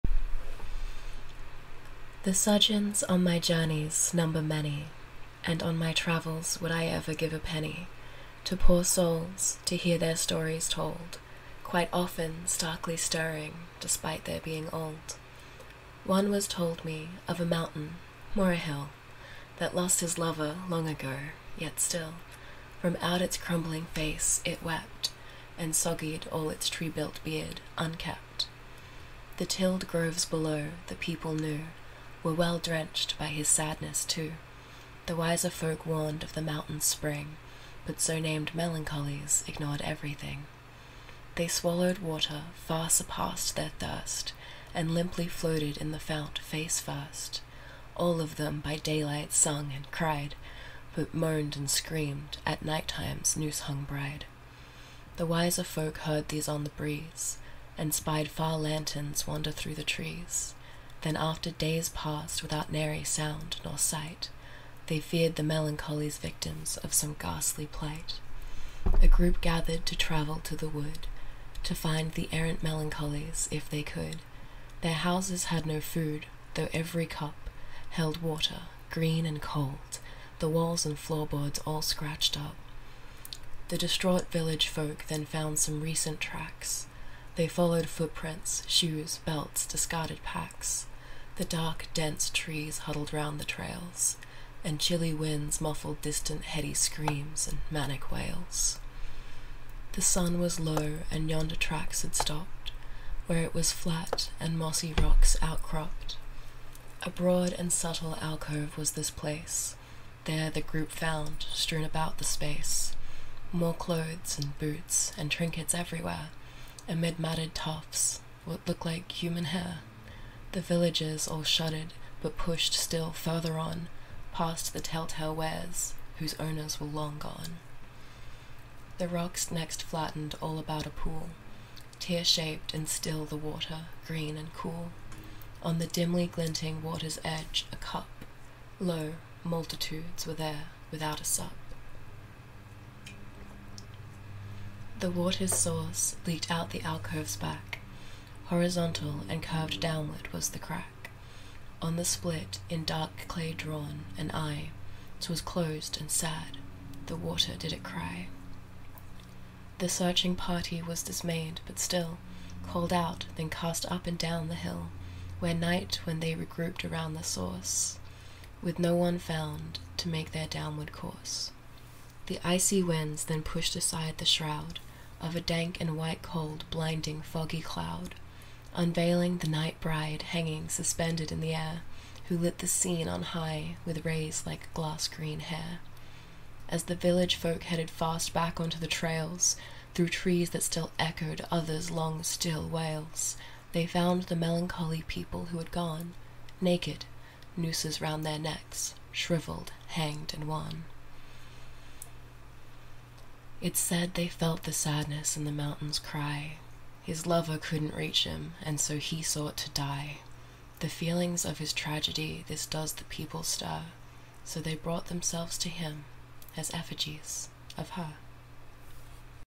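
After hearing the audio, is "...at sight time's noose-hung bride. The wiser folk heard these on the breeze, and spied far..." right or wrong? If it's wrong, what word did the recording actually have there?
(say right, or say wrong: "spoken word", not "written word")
wrong: "night", not "sight".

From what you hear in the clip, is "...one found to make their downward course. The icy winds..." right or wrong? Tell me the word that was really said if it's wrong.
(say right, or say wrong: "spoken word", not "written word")
right.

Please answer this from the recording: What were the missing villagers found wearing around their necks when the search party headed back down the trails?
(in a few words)
nooses.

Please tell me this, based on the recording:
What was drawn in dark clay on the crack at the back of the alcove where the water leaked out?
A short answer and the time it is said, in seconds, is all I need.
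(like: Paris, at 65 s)
an eye, at 154 s.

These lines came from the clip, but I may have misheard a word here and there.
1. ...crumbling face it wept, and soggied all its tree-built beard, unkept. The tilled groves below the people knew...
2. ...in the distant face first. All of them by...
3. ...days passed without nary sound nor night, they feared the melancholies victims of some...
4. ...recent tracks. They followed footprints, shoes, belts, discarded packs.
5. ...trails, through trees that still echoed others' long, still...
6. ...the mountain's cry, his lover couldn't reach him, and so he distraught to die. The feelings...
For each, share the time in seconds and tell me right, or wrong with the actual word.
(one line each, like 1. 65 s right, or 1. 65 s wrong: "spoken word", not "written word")
1. 23 s right
2. 45 s wrong: "fount", not "distant"
3. 61 s wrong: "sight", not "night"
4. 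85 s right
5. 188 s right
6. 205 s wrong: "sought", not "distraught".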